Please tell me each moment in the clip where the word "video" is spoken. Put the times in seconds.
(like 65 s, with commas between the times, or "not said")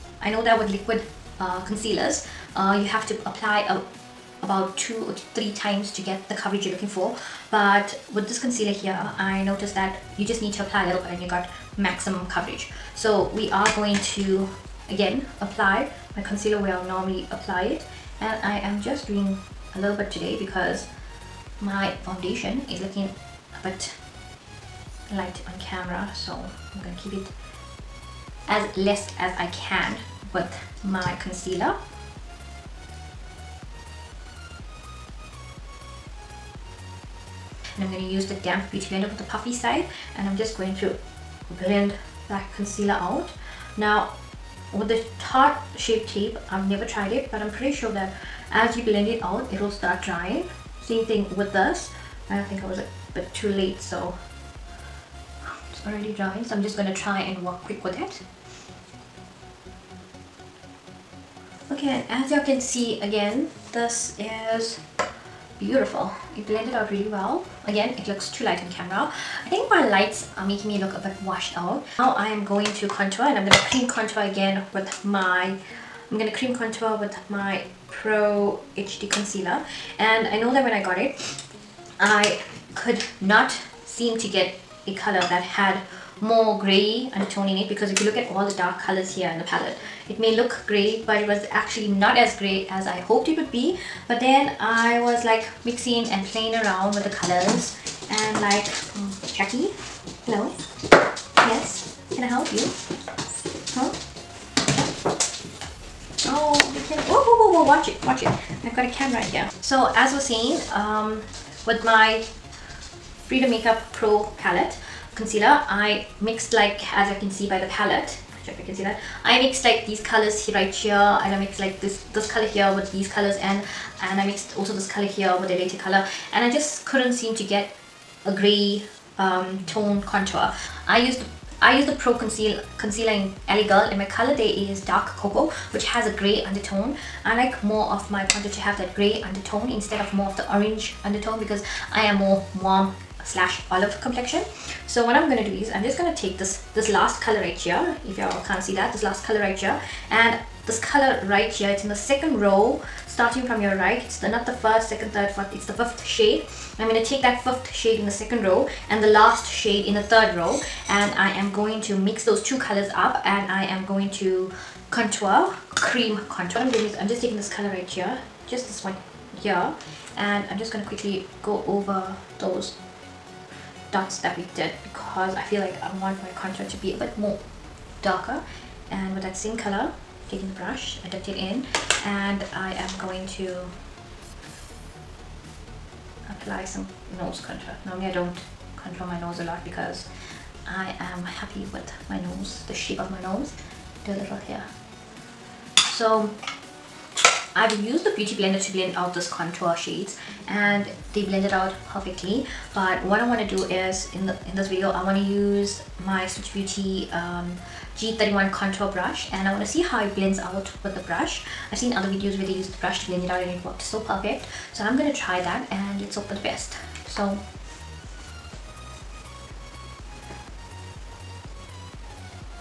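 204 s, 212 s.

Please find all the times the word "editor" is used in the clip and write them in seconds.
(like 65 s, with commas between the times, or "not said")
not said.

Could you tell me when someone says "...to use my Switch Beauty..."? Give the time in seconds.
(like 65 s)
205 s.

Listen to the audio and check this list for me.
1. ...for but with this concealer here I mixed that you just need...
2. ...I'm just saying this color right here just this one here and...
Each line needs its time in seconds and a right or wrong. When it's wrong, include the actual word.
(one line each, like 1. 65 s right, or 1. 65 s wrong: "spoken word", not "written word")
1. 6 s wrong: "noticed", not "mixed"
2. 166 s wrong: "taking", not "saying".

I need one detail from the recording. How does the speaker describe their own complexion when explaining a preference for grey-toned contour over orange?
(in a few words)
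warm slash olive.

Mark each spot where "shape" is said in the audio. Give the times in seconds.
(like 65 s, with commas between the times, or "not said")
45 s, 192 s.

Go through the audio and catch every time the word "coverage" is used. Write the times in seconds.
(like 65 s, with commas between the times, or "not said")
6 s, 12 s.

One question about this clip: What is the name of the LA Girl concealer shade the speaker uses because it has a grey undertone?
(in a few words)
dark cocoa.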